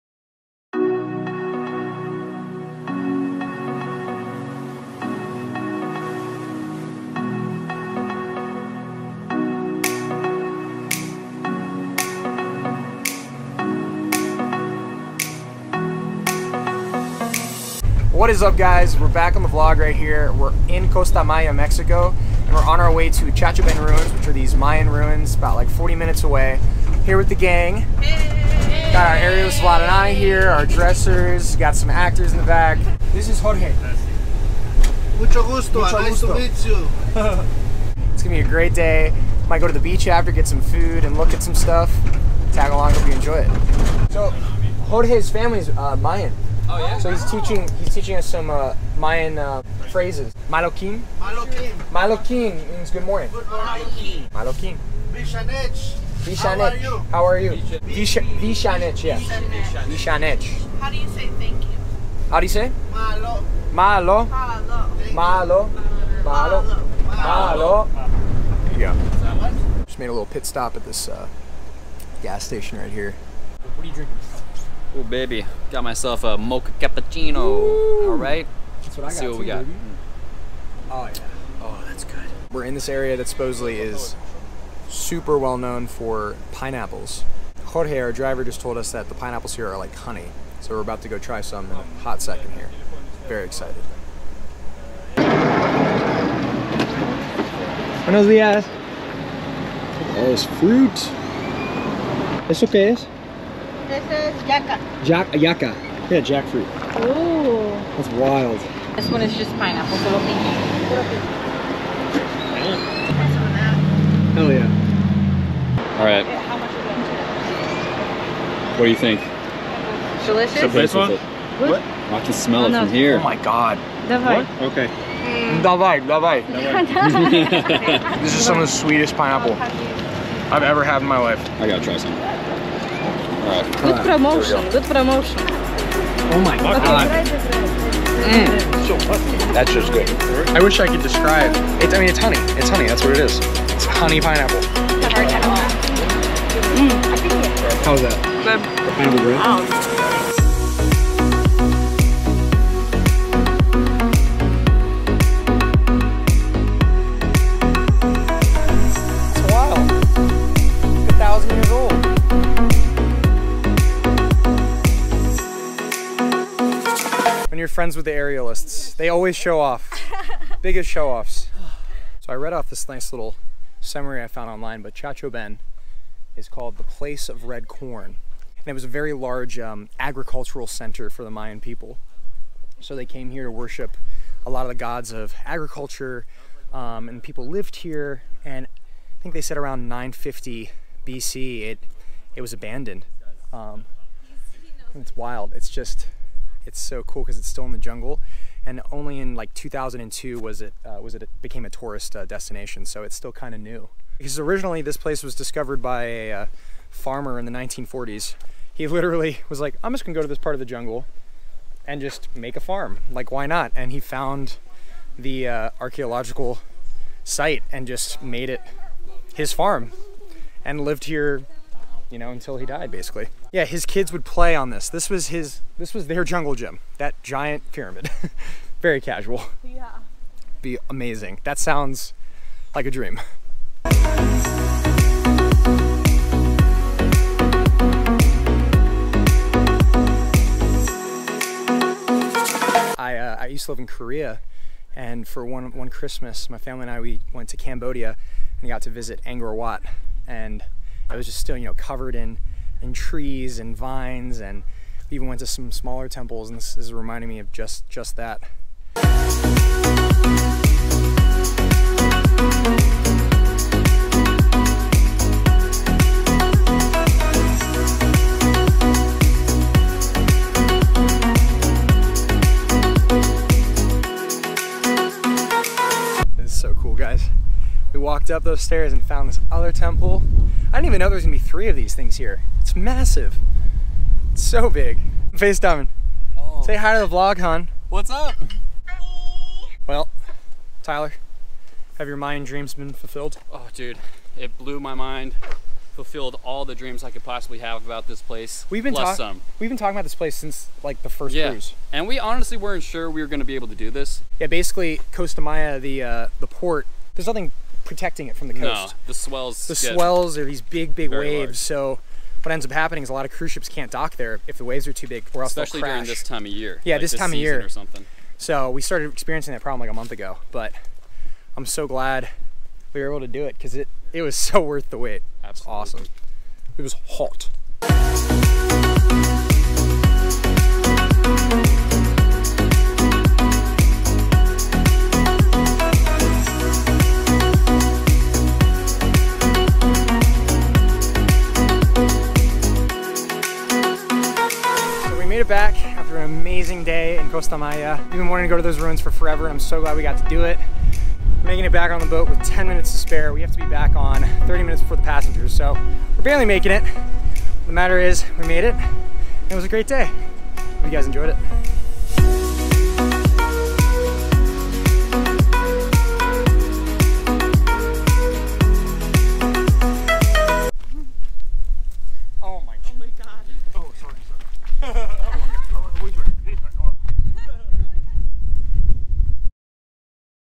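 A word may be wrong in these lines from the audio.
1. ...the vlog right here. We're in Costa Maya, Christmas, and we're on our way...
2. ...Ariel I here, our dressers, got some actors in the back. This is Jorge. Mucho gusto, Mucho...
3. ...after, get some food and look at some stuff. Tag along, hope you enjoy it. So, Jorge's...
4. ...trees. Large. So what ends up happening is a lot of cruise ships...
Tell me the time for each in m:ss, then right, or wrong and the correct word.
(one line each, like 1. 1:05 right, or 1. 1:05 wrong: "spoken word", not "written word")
1. 0:19 wrong: "Mexico", not "Christmas"
2. 0:29 right
3. 0:40 right
4. 5:11 wrong: "waves", not "trees".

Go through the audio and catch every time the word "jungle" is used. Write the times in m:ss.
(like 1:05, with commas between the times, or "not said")
3:17, 3:30, 3:46.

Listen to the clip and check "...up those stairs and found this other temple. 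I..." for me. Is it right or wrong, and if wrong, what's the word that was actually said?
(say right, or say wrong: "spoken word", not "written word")
right.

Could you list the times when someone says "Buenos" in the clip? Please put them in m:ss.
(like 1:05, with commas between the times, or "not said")
1:38.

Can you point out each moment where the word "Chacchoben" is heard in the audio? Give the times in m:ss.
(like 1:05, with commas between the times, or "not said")
0:23, 2:54.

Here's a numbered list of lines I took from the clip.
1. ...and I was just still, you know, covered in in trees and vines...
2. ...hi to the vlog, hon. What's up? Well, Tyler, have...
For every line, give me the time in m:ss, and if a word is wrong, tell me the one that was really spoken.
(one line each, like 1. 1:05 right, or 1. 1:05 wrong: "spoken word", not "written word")
1. 4:10 right
2. 4:46 right.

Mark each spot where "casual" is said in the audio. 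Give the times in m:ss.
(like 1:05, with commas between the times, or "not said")
3:48.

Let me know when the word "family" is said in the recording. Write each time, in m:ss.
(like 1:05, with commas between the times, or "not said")
0:45, 4:06.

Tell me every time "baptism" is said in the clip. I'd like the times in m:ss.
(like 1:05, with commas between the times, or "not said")
not said.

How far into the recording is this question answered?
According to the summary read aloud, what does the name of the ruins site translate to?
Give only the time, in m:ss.
2:56.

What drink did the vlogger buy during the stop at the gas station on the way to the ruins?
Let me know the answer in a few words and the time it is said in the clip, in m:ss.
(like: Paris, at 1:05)
Mocha cappuccino, at 1:16.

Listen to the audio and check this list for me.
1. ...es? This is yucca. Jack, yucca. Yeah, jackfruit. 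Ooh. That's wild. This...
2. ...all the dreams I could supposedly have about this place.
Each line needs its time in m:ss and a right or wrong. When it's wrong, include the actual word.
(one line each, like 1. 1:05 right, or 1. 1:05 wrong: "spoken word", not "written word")
1. 1:42 right
2. 4:56 wrong: "possibly", not "supposedly".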